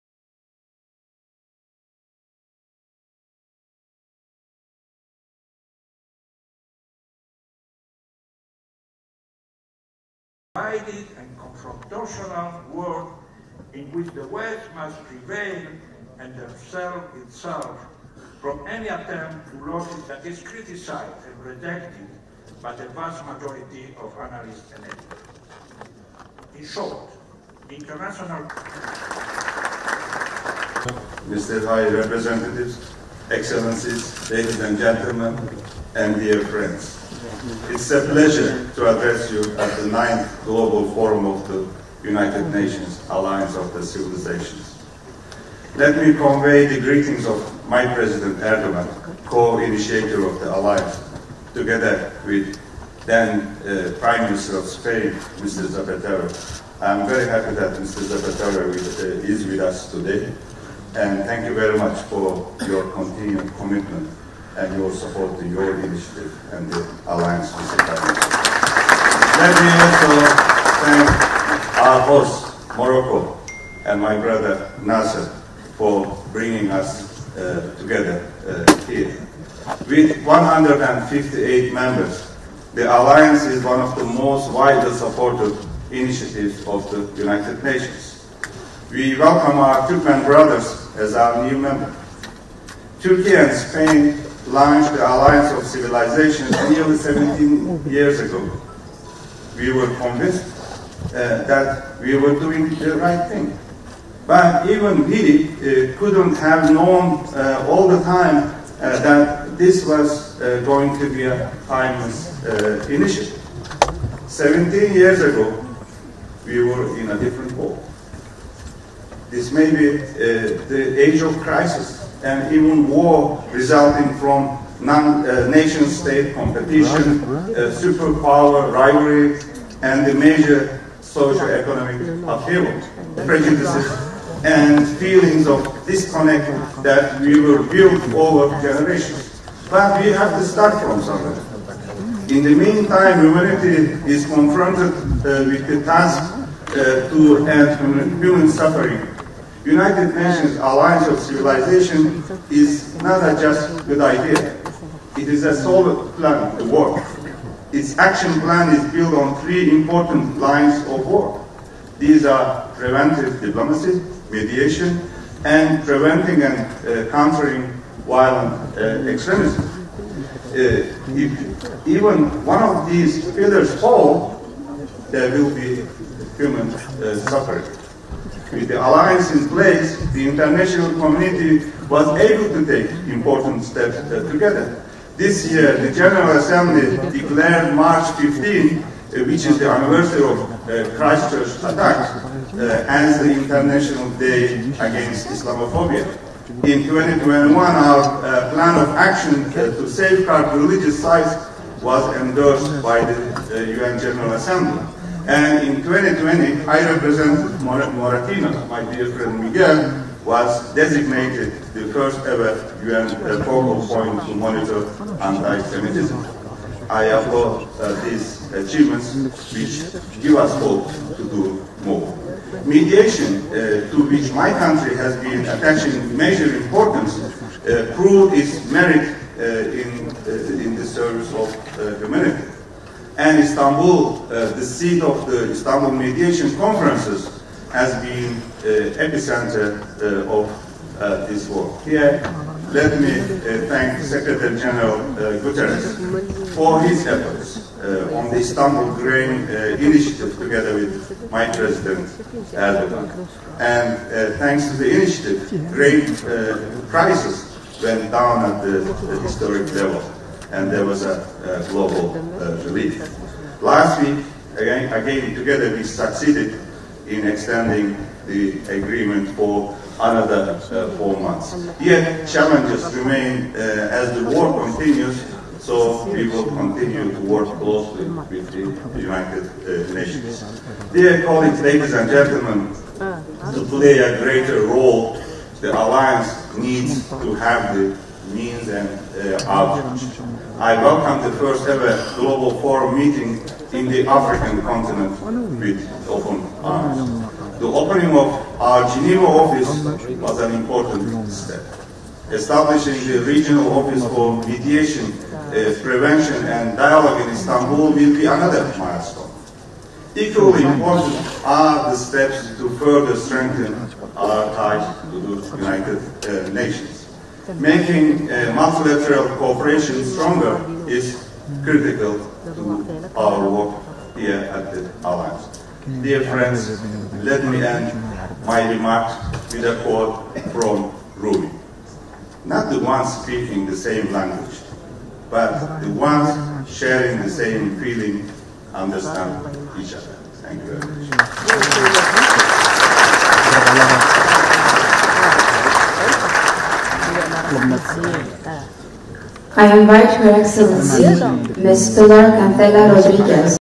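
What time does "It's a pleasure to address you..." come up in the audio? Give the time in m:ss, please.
0:37.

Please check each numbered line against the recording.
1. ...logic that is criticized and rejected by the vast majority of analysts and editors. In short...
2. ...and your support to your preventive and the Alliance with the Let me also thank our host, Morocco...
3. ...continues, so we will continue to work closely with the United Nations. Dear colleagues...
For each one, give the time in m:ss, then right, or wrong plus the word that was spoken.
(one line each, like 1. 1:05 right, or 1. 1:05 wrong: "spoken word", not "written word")
1. 0:19 right
2. 1:04 wrong: "initiative", not "preventive"
3. 4:34 right.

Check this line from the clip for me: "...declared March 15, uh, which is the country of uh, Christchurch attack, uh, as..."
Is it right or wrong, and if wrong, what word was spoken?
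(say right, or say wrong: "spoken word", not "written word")
wrong: "anniversary", not "country".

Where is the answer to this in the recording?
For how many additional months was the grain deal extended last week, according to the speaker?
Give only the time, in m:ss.
4:30.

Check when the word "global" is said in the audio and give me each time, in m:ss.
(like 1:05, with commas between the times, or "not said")
0:40, 4:21, 4:52.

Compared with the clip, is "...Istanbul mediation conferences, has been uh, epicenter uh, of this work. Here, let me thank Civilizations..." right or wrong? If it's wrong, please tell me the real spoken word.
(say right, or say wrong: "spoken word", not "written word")
wrong: "Secretary", not "Civilizations".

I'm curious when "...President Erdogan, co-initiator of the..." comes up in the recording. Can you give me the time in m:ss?
0:47.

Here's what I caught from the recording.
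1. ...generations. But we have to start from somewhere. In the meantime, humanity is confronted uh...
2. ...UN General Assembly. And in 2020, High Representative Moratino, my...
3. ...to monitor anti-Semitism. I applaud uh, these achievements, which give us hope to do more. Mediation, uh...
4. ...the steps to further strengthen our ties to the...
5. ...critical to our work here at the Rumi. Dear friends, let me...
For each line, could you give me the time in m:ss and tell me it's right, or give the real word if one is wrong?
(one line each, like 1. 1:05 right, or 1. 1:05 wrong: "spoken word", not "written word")
1. 2:18 right
2. 3:23 right
3. 3:34 right
4. 5:11 right
5. 5:21 wrong: "Alliance", not "Rumi".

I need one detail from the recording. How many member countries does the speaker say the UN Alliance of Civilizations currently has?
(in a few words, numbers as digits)
158.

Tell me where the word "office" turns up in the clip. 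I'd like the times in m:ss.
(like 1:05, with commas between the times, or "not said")
4:59, 5:03.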